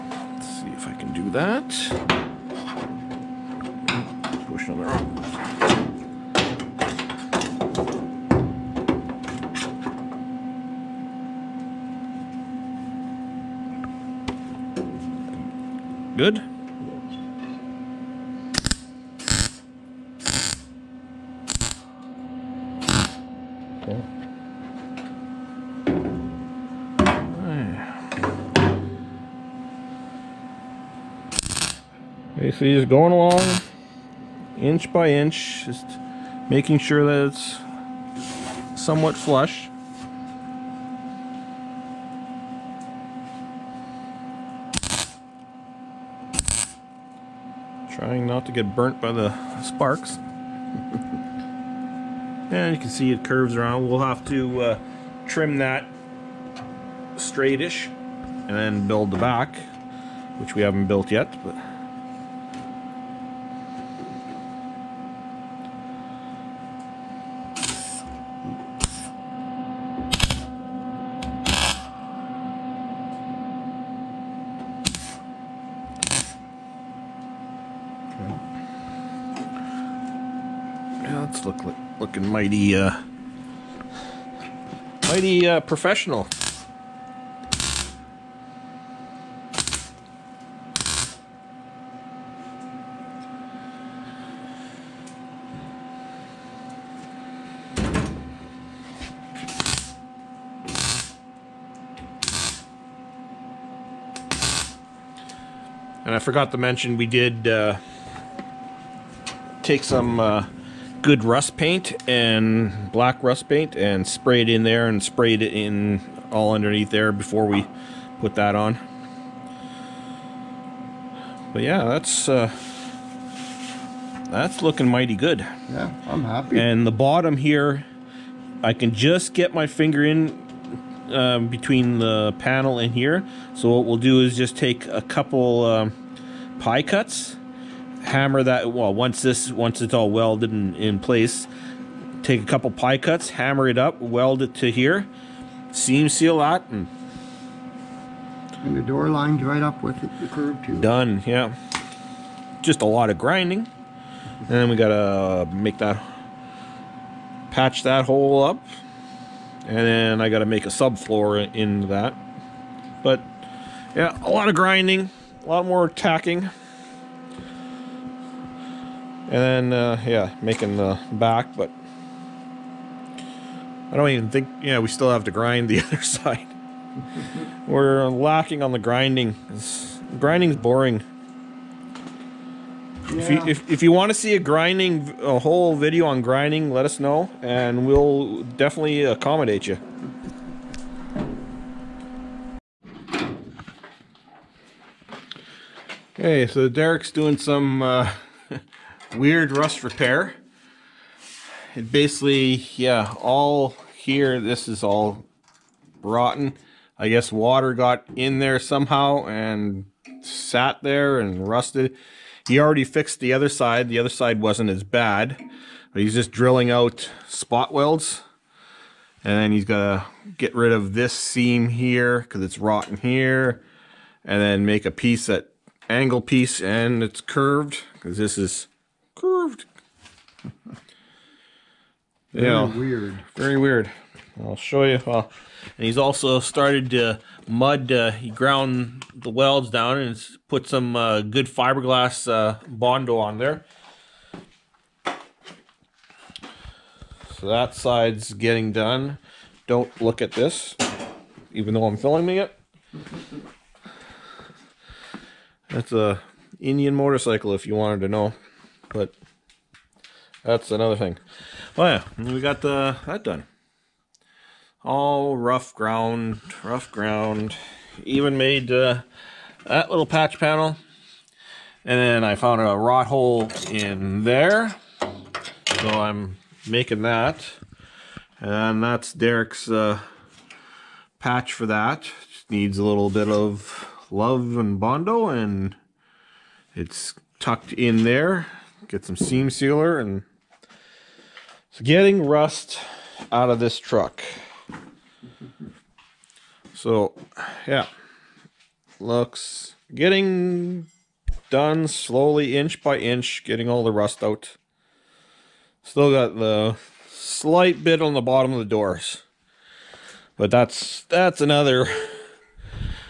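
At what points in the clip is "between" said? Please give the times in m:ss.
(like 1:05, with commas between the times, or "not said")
2:11.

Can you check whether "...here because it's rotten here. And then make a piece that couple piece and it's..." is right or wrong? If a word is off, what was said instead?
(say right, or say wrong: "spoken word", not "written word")
wrong: "angle", not "couple".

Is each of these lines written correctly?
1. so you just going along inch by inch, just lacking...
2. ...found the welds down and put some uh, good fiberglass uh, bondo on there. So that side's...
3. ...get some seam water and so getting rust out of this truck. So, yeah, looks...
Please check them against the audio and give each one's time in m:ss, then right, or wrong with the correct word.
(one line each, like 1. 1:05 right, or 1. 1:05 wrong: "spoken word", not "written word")
1. 0:32 wrong: "making", not "lacking"
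2. 3:58 wrong: "ground", not "found"
3. 4:48 wrong: "sealer", not "water".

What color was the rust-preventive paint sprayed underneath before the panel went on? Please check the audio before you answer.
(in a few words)
Black.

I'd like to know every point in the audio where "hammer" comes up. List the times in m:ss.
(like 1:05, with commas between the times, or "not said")
2:18, 2:23.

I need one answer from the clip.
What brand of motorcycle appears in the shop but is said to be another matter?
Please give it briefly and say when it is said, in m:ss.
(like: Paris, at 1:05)
Indian, at 4:16.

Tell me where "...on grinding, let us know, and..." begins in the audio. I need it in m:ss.
3:06.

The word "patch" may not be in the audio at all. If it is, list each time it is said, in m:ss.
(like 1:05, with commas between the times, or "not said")
2:37, 4:30, 4:41.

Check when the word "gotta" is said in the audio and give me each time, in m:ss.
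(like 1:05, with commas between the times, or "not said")
2:34, 2:40.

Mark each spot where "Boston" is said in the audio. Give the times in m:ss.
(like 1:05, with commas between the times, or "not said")
not said.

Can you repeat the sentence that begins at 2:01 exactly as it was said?
But yeah, that's uh, that's looking mighty good.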